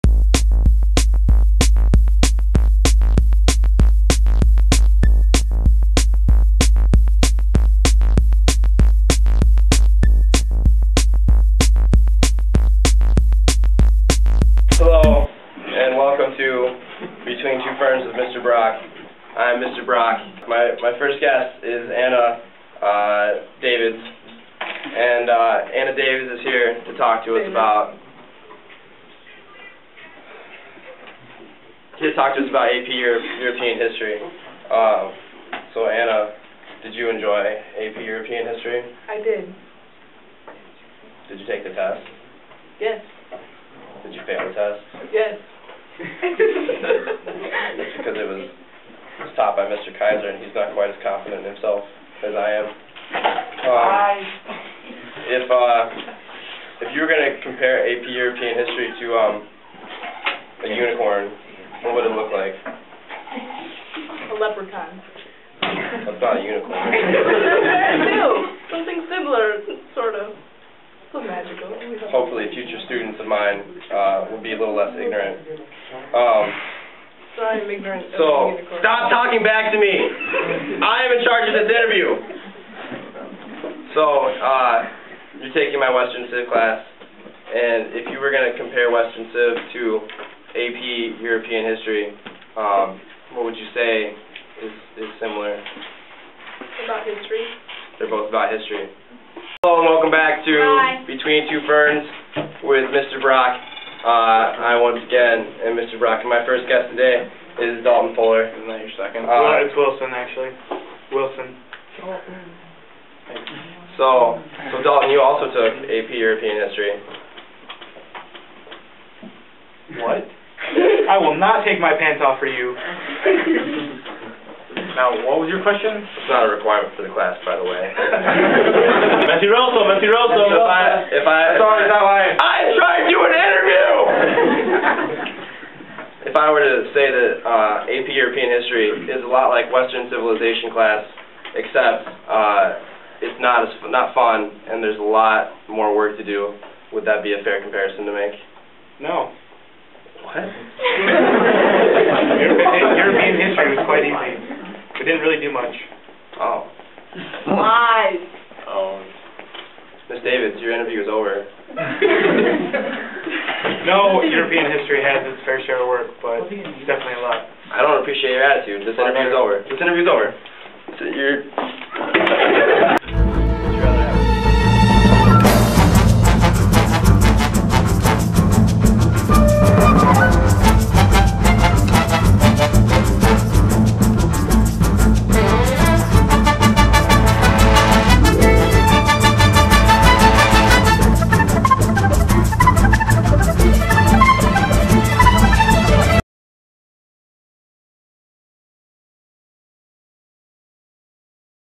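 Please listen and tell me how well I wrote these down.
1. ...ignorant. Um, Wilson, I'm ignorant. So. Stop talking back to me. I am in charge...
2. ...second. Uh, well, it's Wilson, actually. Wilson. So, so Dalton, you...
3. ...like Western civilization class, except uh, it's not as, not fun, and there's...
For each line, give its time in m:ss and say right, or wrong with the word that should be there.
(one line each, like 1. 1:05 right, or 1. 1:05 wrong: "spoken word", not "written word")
1. 1:14 wrong: "Sorry", not "Wilson"
2. 1:49 right
3. 2:19 right.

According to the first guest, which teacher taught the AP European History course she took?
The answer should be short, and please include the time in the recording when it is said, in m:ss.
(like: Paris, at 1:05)
Mr. Kaiser, at 0:49.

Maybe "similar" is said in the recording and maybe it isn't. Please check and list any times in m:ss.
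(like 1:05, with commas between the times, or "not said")
1:09, 1:35.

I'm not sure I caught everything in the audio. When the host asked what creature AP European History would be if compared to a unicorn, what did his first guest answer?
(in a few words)
A leprechaun.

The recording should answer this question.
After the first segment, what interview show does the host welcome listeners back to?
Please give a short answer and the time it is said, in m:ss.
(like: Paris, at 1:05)
Between Two Ferns, at 1:41.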